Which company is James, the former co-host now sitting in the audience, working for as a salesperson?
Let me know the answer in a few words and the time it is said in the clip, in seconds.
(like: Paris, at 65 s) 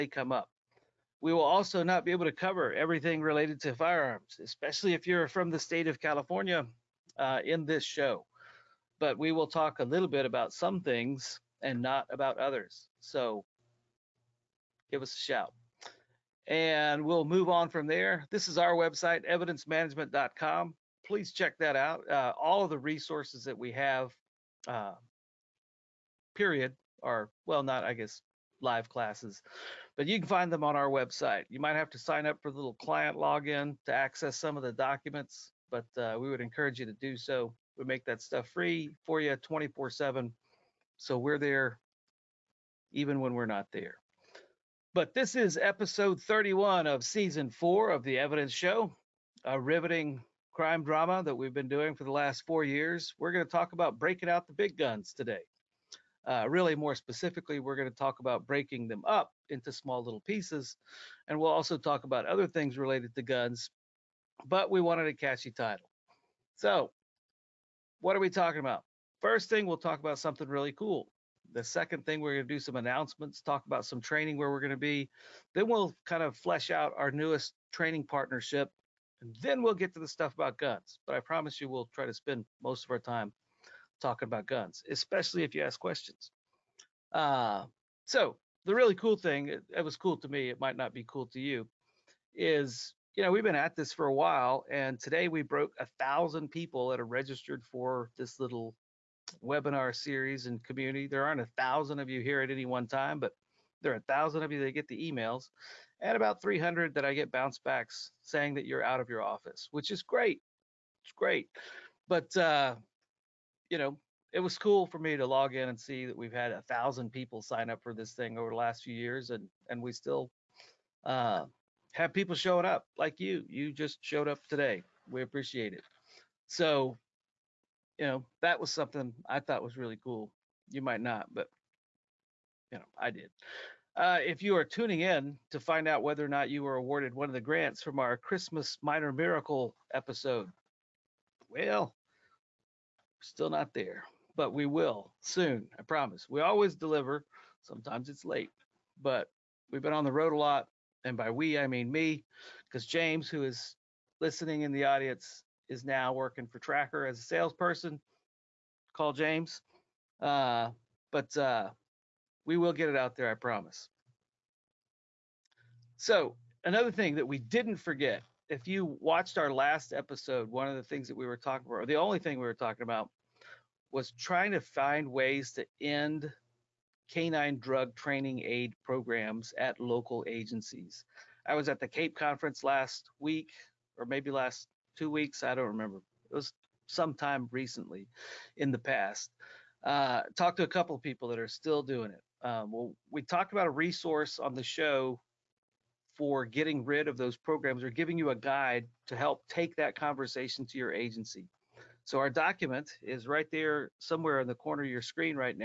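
Tracker, at 156 s.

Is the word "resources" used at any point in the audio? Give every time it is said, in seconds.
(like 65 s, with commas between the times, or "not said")
22 s, 193 s.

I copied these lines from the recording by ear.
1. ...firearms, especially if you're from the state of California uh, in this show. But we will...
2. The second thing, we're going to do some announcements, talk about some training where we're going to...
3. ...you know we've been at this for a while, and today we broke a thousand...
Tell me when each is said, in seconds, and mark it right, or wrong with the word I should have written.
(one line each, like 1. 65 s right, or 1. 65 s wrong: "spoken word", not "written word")
1. 3 s right
2. 71 s right
3. 93 s right.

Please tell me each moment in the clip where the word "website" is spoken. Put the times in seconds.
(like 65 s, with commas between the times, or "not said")
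18 s, 30 s.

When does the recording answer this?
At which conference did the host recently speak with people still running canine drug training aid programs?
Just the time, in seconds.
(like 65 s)
181 s.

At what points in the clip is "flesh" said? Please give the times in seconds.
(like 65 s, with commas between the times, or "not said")
76 s.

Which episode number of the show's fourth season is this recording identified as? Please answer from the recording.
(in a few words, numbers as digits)
31.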